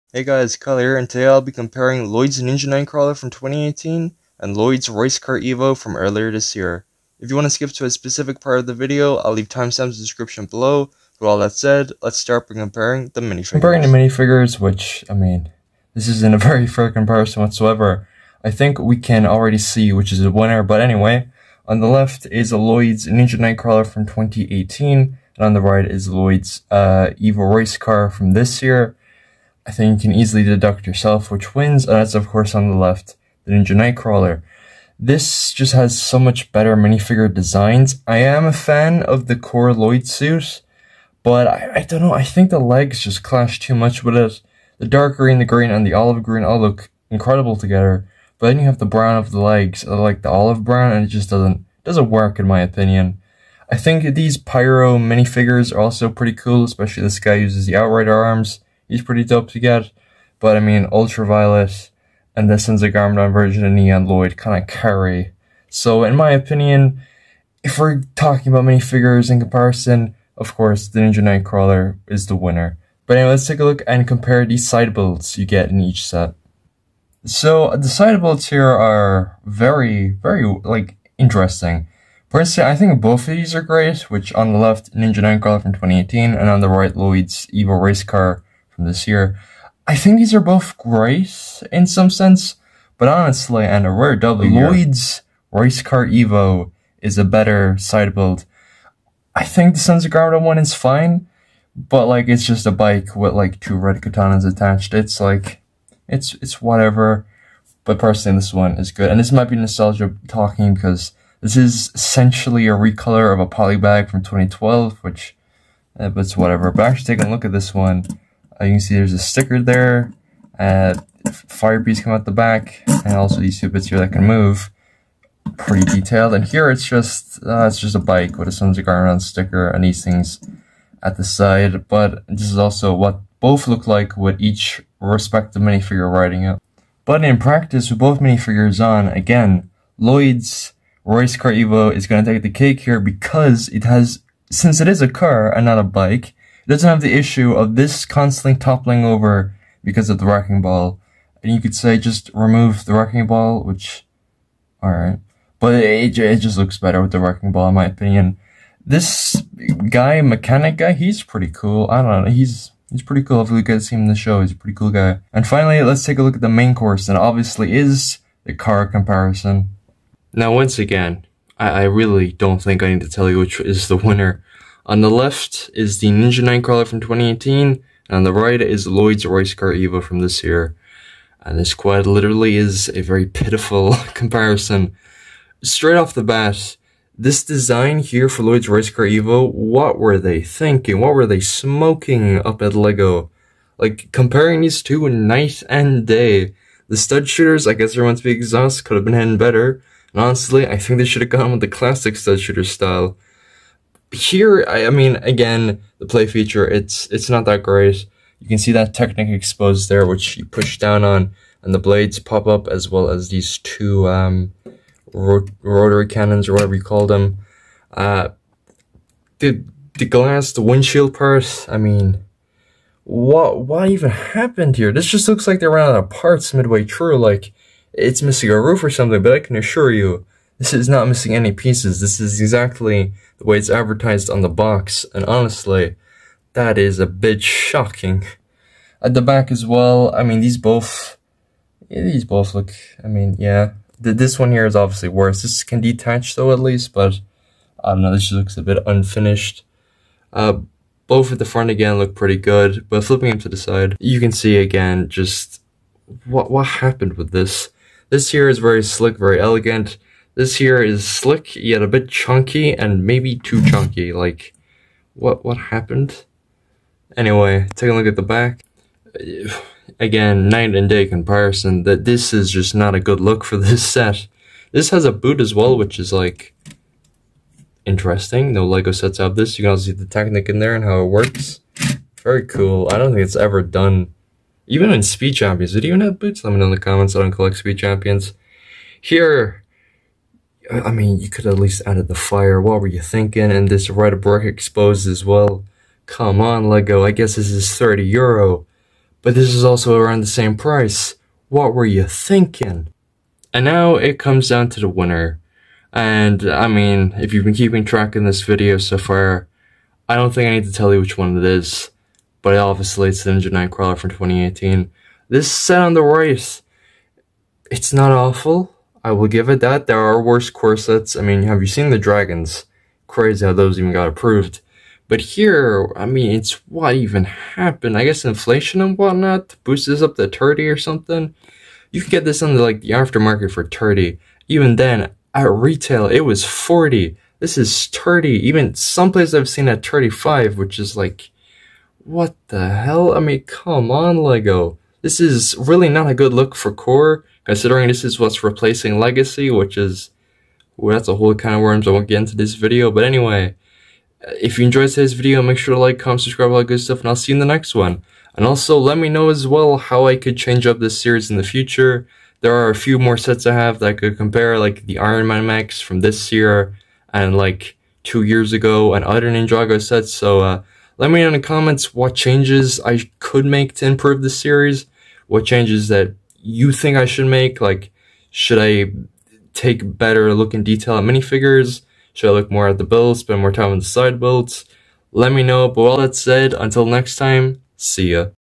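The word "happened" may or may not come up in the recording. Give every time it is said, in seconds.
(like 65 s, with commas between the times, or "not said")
224 s, 256 s, 265 s, 327 s.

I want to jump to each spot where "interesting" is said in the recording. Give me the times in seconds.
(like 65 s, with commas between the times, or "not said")
81 s, 277 s.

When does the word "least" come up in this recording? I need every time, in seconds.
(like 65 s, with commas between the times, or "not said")
246 s, 291 s.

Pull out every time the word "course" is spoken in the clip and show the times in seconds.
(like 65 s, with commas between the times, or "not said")
32 s, 70 s, 166 s.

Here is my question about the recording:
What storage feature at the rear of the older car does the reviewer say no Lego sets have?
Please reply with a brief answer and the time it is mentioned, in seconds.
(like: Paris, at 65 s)
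a boot, at 275 s.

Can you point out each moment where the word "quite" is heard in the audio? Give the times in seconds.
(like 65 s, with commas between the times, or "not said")
181 s.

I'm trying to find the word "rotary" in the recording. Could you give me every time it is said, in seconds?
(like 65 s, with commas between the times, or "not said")
215 s.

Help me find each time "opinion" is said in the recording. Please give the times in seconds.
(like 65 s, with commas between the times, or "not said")
52 s, 66 s, 157 s.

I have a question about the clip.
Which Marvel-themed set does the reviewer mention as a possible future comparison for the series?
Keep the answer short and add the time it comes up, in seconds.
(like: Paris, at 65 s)
Iron Man Max, at 364 s.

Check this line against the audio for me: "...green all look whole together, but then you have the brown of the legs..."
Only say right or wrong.
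wrong.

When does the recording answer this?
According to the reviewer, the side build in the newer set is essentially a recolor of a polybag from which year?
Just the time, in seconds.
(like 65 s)
114 s.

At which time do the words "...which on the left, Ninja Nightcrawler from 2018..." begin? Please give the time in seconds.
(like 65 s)
84 s.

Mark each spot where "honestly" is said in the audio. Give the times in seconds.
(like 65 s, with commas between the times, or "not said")
93 s, 200 s, 235 s.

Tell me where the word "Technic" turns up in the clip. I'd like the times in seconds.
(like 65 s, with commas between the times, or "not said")
208 s, 280 s.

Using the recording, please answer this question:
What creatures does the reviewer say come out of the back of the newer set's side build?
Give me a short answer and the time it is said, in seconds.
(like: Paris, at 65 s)
fire bees, at 121 s.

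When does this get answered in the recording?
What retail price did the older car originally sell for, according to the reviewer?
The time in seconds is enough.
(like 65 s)
336 s.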